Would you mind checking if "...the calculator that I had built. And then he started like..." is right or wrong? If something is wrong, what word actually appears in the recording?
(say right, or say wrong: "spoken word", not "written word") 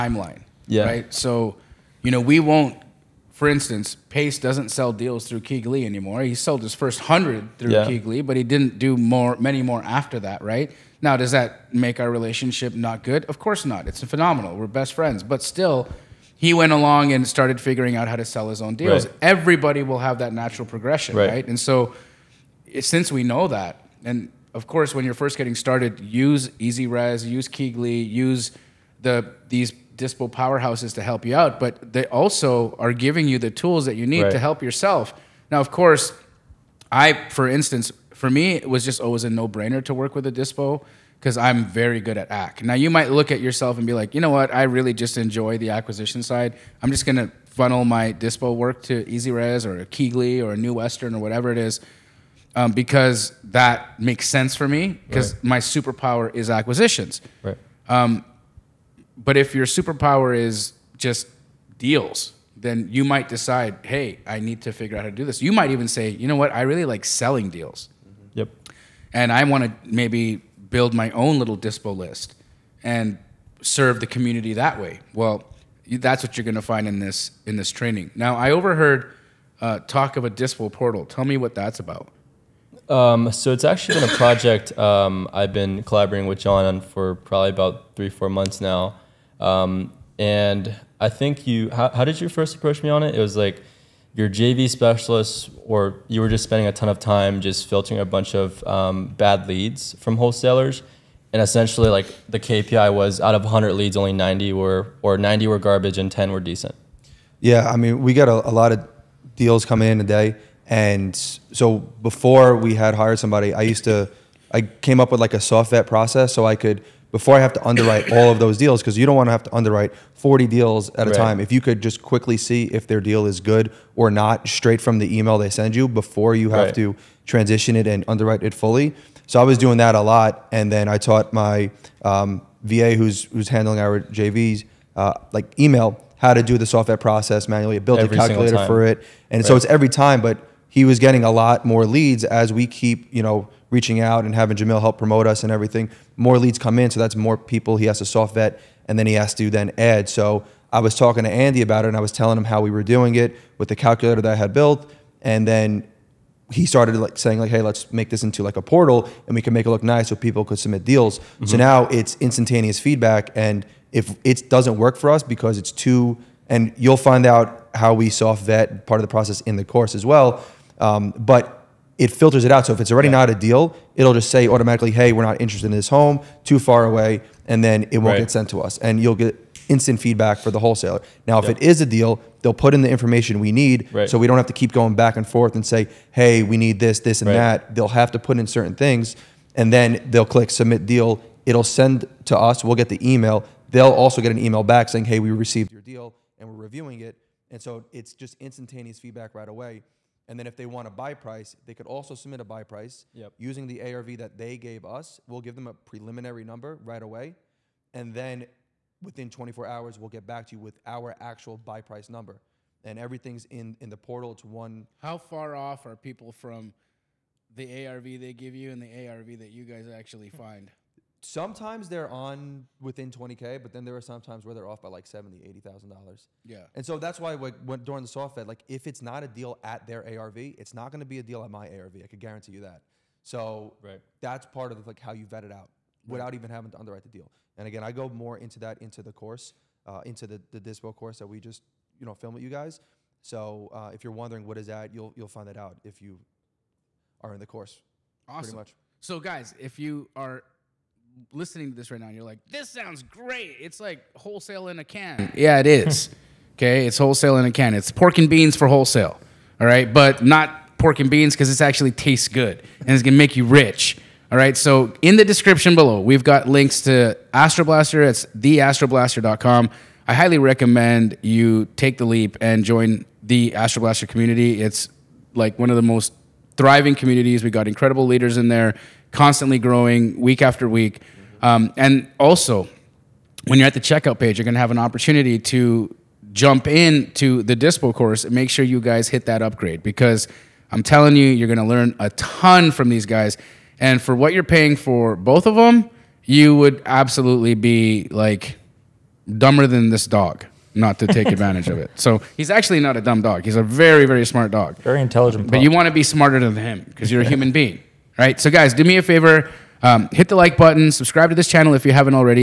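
right.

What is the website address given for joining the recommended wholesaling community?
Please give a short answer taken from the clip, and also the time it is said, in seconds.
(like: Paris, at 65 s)
theastroblaster.com, at 268 s.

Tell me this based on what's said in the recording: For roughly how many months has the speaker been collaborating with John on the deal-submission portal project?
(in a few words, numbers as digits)
3-4 months.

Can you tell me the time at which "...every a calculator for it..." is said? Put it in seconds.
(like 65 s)
137 s.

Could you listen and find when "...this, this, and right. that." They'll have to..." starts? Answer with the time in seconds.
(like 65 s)
186 s.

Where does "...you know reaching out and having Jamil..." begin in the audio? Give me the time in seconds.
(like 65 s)
143 s.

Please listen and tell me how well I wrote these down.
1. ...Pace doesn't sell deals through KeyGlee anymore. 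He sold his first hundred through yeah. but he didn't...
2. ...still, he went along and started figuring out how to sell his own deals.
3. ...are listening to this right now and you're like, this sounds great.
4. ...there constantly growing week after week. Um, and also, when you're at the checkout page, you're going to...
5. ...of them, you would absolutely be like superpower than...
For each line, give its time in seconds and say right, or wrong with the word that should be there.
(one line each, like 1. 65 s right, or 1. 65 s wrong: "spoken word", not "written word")
1. 4 s right
2. 15 s right
3. 250 s right
4. 278 s right
5. 295 s wrong: "dumber", not "superpower".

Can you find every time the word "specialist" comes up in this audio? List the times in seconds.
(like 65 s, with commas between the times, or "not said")
94 s.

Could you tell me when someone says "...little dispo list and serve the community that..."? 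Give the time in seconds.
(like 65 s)
71 s.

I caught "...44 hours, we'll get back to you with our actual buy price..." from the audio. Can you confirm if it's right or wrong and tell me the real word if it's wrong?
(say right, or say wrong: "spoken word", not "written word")
wrong: "24", not "44".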